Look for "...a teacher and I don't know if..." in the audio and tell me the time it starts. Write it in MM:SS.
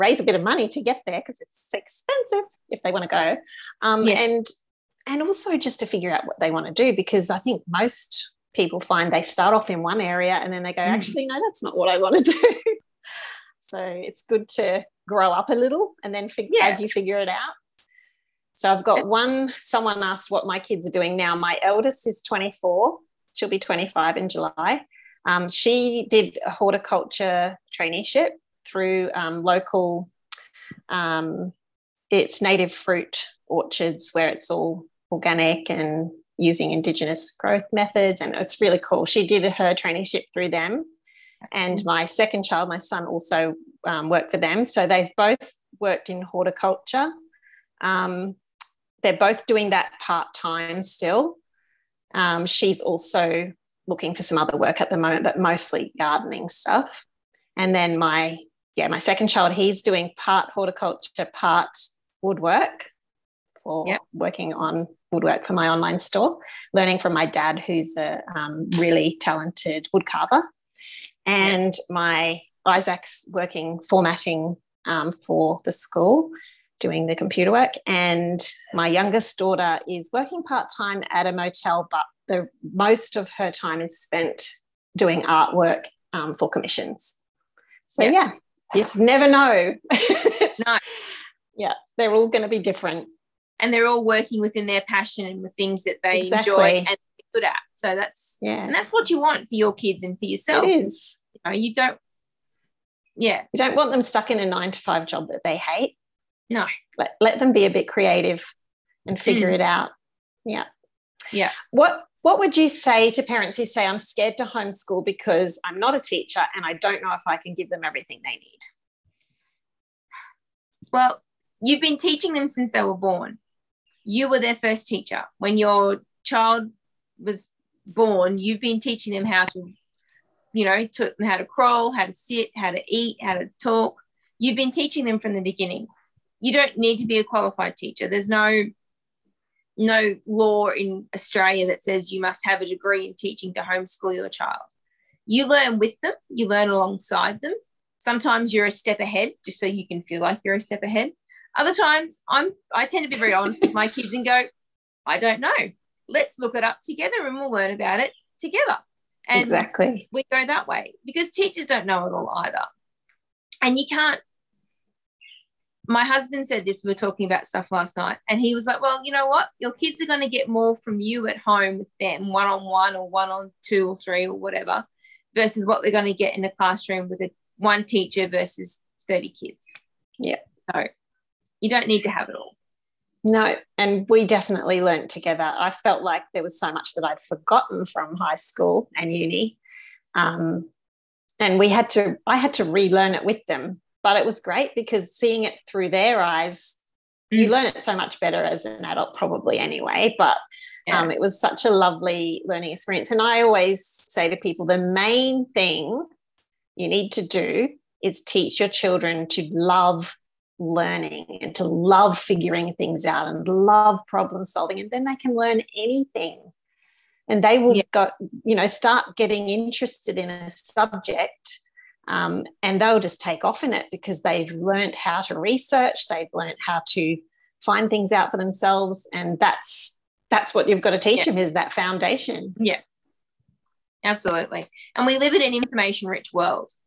01:55.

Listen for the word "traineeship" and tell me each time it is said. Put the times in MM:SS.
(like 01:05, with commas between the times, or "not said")
00:27, 00:39.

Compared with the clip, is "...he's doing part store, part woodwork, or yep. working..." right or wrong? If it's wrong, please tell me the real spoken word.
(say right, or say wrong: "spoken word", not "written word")
wrong: "horticulture", not "store".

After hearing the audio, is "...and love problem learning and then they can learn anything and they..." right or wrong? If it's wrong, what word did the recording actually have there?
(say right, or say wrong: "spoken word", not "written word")
wrong: "solving", not "learning".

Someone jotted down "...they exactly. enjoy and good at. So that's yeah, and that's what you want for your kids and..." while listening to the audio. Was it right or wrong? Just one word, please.
right.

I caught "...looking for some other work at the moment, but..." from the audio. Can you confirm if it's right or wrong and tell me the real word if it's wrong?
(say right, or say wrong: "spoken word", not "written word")
right.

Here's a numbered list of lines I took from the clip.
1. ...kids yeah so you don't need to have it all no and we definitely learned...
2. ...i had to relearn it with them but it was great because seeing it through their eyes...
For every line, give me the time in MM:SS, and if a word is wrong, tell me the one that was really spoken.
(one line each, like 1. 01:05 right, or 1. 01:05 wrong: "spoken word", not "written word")
1. 02:59 right
2. 03:12 right.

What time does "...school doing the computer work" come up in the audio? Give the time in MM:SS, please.
01:15.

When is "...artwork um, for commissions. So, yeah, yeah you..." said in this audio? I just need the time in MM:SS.
01:25.